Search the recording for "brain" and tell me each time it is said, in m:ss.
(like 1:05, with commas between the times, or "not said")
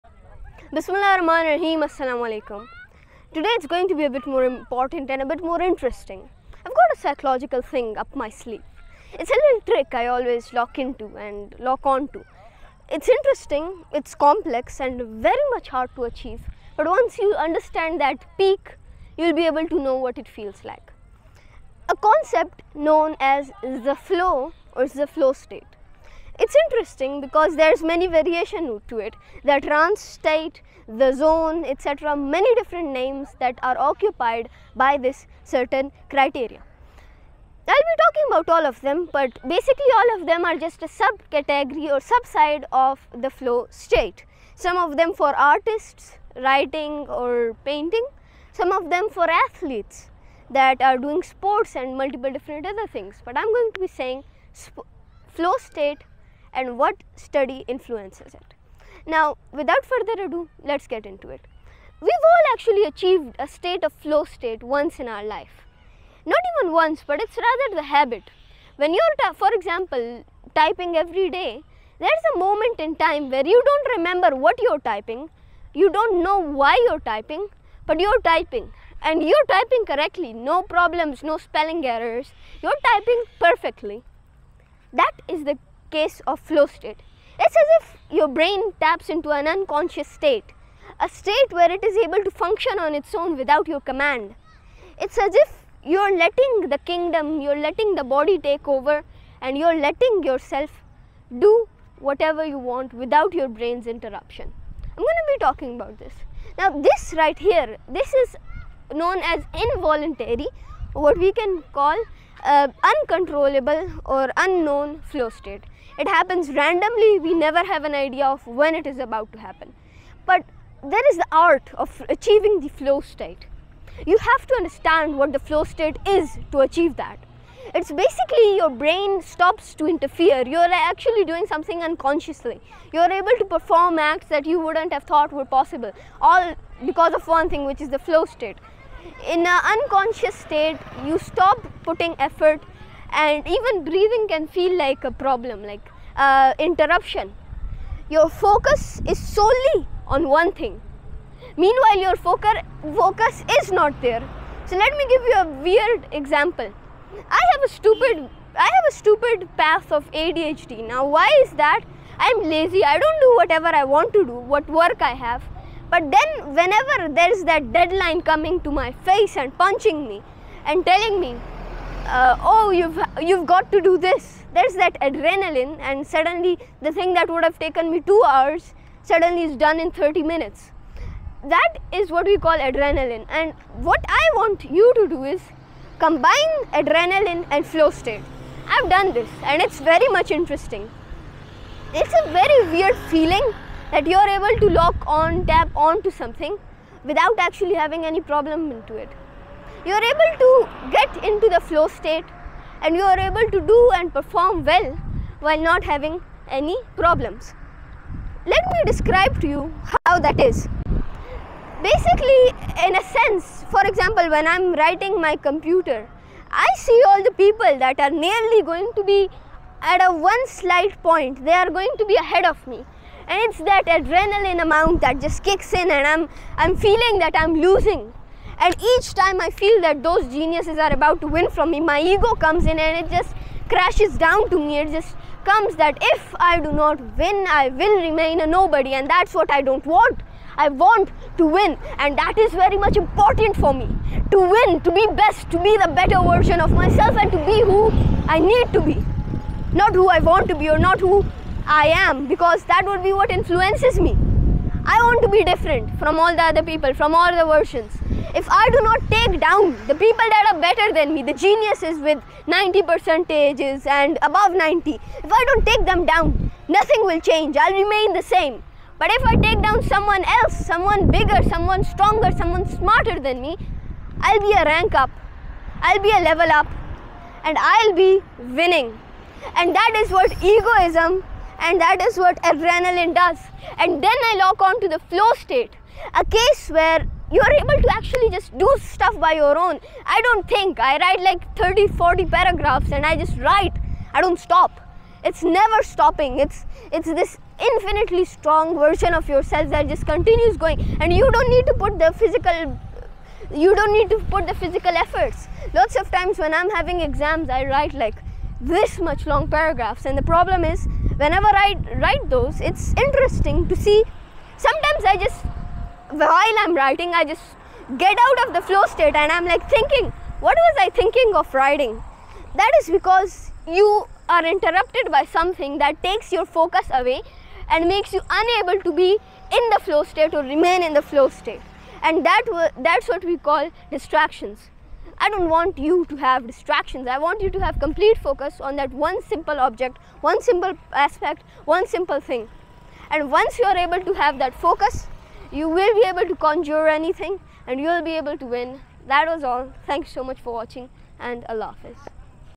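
1:28, 1:43, 2:08.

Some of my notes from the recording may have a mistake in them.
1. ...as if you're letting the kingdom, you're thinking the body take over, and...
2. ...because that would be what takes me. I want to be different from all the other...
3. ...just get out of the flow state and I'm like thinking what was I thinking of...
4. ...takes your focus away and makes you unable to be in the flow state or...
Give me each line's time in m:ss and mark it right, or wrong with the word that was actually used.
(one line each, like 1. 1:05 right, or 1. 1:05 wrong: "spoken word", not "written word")
1. 1:35 wrong: "letting", not "thinking"
2. 4:12 wrong: "influences", not "takes"
3. 5:17 right
4. 5:26 right.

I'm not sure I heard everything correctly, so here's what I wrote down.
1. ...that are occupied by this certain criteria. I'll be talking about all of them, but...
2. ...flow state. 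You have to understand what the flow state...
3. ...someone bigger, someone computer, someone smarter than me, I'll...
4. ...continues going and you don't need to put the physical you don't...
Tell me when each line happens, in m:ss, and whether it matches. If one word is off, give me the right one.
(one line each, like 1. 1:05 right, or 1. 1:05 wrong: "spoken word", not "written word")
1. 0:33 right
2. 2:02 right
3. 4:30 wrong: "stronger", not "computer"
4. 5:00 right.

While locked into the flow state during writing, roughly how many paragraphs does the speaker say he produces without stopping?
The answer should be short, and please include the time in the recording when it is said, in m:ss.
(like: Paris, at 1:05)
30 to 40, at 4:51.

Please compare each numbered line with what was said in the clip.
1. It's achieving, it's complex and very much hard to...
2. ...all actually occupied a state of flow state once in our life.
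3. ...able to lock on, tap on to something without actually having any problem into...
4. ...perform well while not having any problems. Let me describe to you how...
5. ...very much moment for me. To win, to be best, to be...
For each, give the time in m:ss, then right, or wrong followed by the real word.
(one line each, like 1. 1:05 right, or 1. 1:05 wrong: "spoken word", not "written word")
1. 0:12 wrong: "interesting", not "achieving"
2. 1:02 wrong: "achieved", not "occupied"
3. 3:14 right
4. 3:24 right
5. 4:02 wrong: "important", not "moment".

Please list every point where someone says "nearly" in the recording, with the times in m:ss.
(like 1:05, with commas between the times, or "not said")
3:38.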